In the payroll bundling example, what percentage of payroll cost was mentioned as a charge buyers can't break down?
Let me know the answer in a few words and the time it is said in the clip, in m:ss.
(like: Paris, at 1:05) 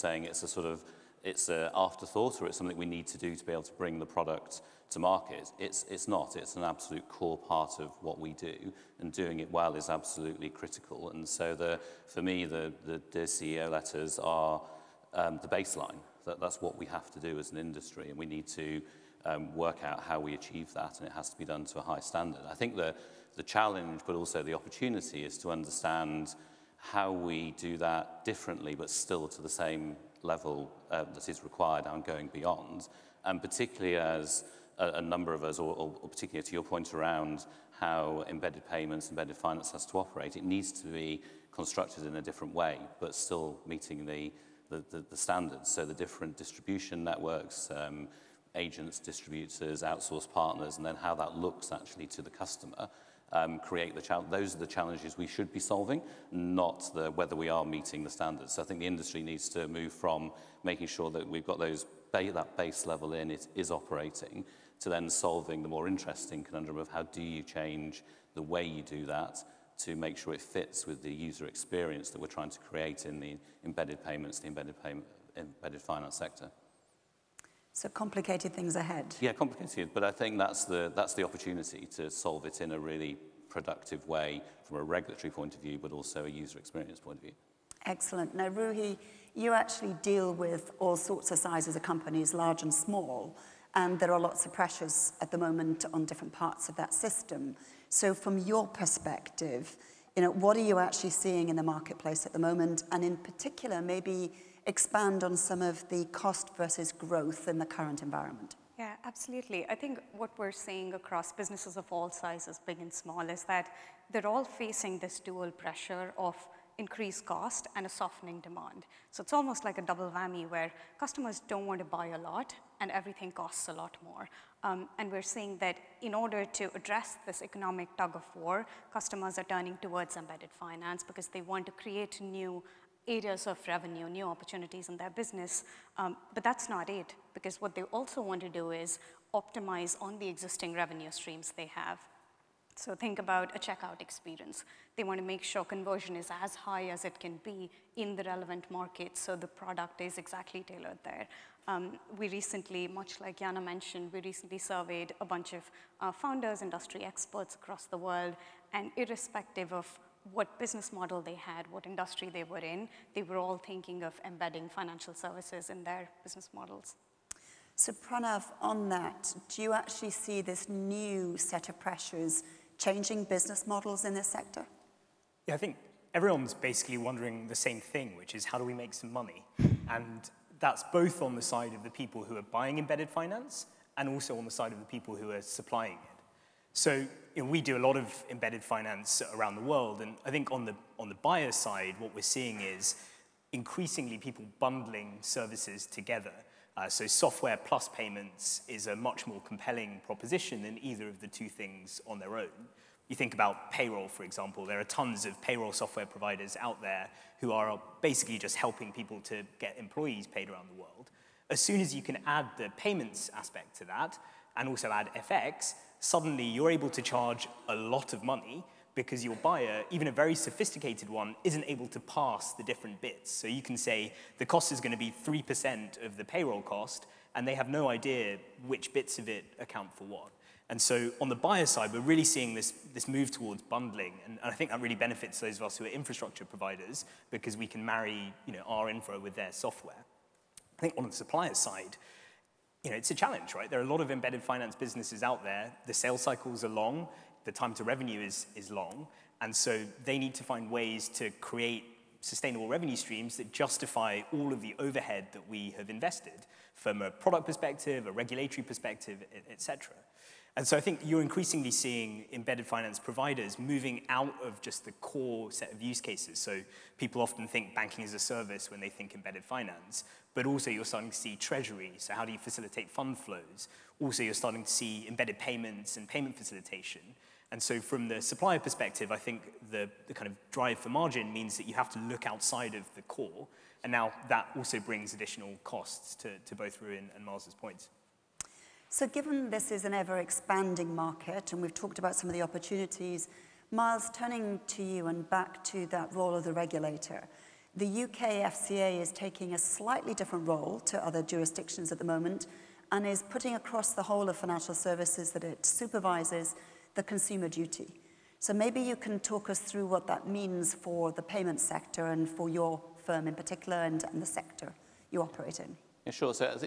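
3%, at 3:45.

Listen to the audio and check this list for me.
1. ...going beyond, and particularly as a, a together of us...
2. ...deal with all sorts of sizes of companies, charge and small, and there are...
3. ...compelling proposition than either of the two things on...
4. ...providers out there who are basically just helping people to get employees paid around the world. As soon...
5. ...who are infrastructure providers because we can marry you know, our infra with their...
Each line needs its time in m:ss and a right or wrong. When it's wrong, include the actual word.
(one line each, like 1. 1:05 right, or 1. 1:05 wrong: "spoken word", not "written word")
1. 0:32 wrong: "number", not "together"
2. 1:30 wrong: "large", not "charge"
3. 3:19 right
4. 3:26 right
5. 3:55 right.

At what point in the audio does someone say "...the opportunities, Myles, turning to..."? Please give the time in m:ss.
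4:52.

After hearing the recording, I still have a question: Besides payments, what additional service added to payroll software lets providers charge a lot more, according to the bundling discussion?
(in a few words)
FX.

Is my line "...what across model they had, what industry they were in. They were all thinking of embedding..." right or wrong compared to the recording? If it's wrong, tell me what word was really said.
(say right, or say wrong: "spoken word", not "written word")
wrong: "business", not "across".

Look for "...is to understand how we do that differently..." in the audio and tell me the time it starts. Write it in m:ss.
0:25.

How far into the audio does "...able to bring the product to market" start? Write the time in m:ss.
0:03.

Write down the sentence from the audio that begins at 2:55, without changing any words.
Yeah, I think everyone's basically wondering the same thing, which is how do we make some money?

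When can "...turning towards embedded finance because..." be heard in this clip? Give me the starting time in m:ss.
2:09.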